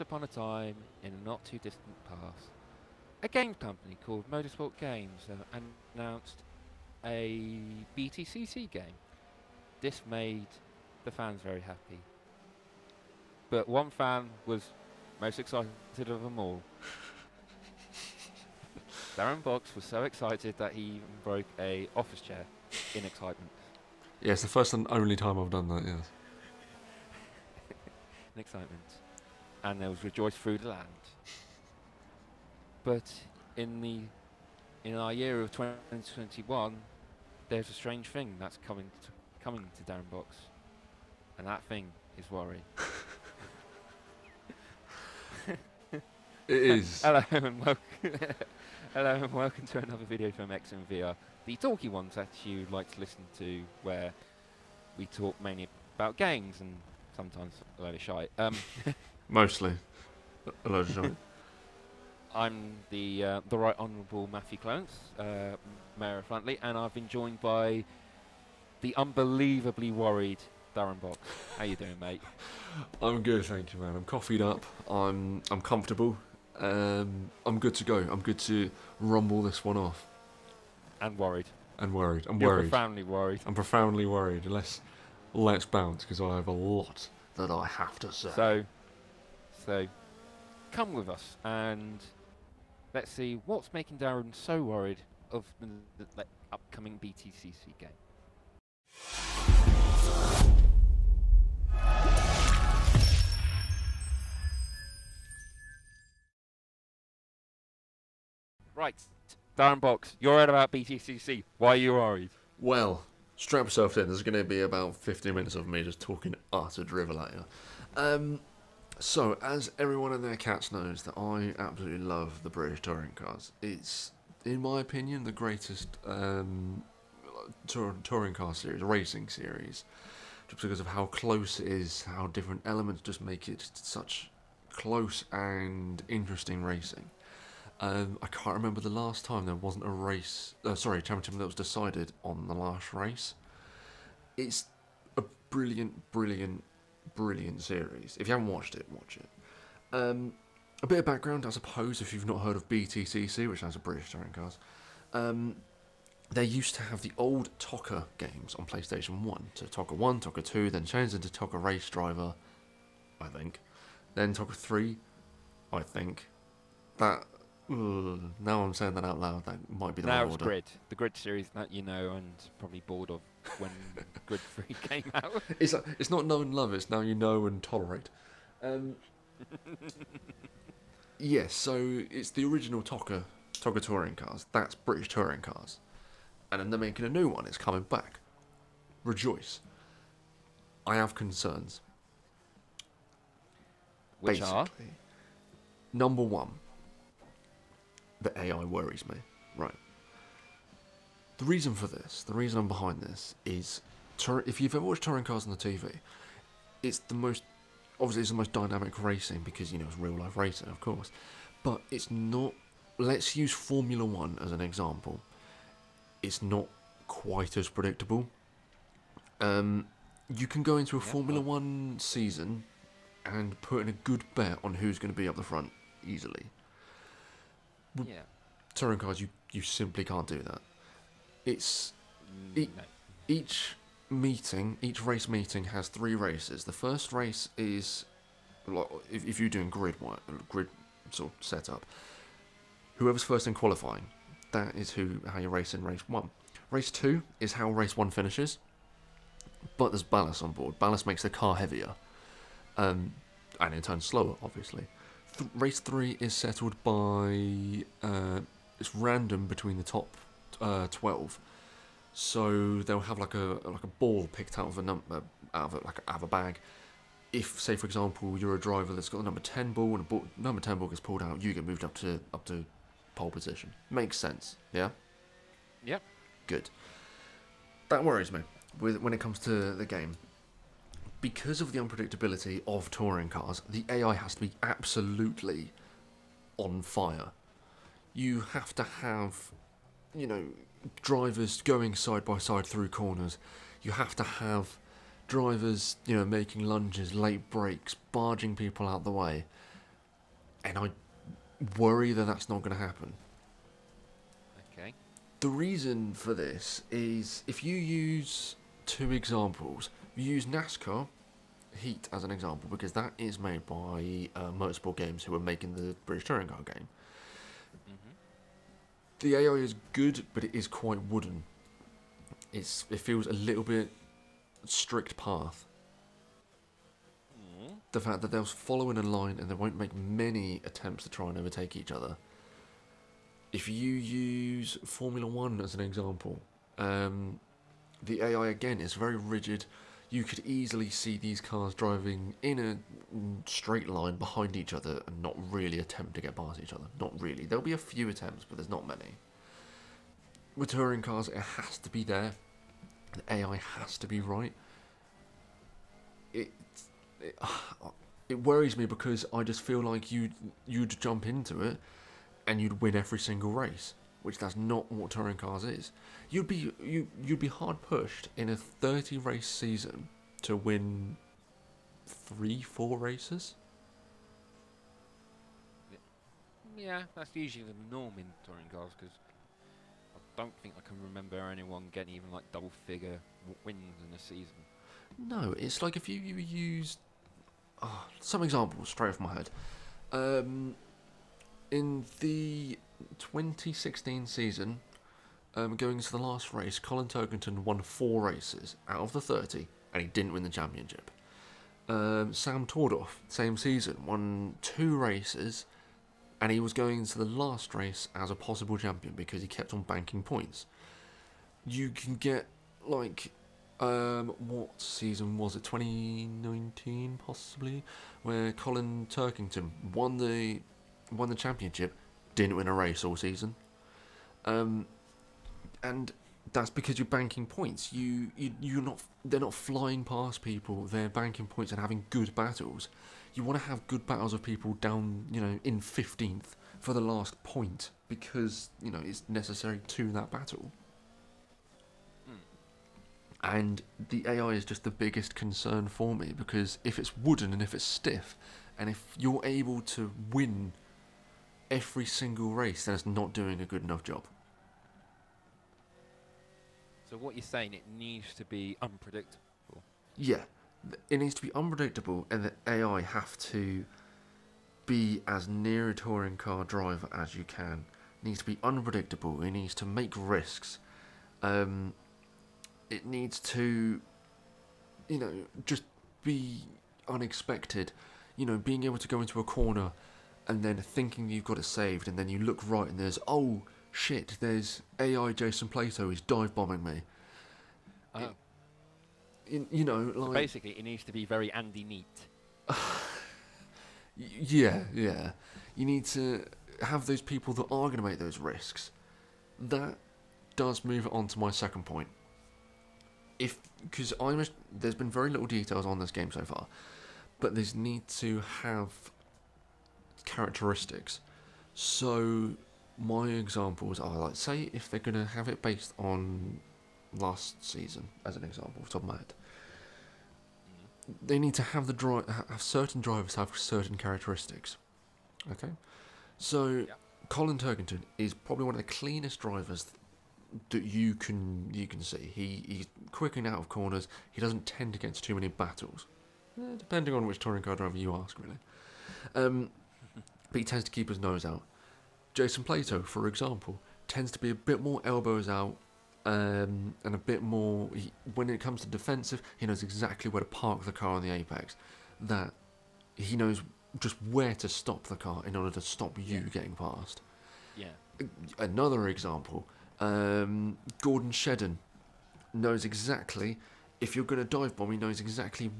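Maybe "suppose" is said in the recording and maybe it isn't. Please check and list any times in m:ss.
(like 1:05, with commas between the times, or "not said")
2:31.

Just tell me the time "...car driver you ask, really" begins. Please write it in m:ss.
8:57.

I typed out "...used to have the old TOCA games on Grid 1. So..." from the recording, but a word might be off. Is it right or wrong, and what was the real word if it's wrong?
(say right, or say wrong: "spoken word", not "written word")
wrong: "PlayStation", not "Grid".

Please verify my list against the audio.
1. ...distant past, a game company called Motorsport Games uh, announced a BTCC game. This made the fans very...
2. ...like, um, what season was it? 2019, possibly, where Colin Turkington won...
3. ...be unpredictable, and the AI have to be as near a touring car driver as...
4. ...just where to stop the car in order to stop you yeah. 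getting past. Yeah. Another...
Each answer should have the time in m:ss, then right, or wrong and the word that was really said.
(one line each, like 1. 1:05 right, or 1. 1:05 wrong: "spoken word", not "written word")
1. 0:01 right
2. 6:52 right
3. 7:41 right
4. 9:13 right.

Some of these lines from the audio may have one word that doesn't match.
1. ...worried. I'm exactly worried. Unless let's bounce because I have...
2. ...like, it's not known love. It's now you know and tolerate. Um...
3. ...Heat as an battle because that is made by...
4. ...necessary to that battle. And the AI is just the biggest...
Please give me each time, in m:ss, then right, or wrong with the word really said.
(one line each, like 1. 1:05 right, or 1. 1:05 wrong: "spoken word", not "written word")
1. 1:23 wrong: "profoundly", not "exactly"
2. 2:55 right
3. 5:11 wrong: "example", not "battle"
4. 7:19 right.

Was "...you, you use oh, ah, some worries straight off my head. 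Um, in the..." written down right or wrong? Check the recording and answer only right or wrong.
wrong.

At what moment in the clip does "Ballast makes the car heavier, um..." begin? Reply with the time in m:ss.
4:10.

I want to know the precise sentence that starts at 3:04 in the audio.
That's British touring cars, and then they're making a new one.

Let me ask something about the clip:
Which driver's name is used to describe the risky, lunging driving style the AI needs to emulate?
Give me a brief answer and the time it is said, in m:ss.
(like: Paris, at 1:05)
Andy Neate, at 8:11.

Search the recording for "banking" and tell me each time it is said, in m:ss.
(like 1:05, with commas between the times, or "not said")
6:49, 7:07, 7:11.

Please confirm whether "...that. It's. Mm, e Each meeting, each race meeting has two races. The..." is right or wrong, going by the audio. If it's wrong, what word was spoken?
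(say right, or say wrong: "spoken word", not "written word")
wrong: "three", not "two".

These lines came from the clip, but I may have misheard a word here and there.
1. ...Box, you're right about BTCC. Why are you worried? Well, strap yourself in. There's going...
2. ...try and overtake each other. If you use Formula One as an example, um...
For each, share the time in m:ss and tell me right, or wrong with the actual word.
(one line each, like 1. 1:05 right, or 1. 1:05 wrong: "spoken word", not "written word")
1. 1:49 right
2. 5:31 right.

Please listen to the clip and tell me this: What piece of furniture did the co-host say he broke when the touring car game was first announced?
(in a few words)
office chair.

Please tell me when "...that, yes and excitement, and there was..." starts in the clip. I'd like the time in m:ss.
0:25.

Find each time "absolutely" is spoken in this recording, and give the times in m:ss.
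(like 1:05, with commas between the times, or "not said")
2:01, 4:44.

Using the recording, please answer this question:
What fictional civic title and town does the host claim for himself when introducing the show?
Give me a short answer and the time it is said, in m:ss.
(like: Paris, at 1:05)
Mayor of Flantley, at 1:05.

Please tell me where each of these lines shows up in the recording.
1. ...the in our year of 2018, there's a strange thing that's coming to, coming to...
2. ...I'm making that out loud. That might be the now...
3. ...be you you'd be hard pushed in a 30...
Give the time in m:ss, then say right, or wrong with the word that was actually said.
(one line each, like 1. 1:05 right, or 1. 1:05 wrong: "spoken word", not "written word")
1. 0:33 wrong: "2021", not "2018"
2. 2:48 wrong: "saying", not "making"
3. 6:06 right.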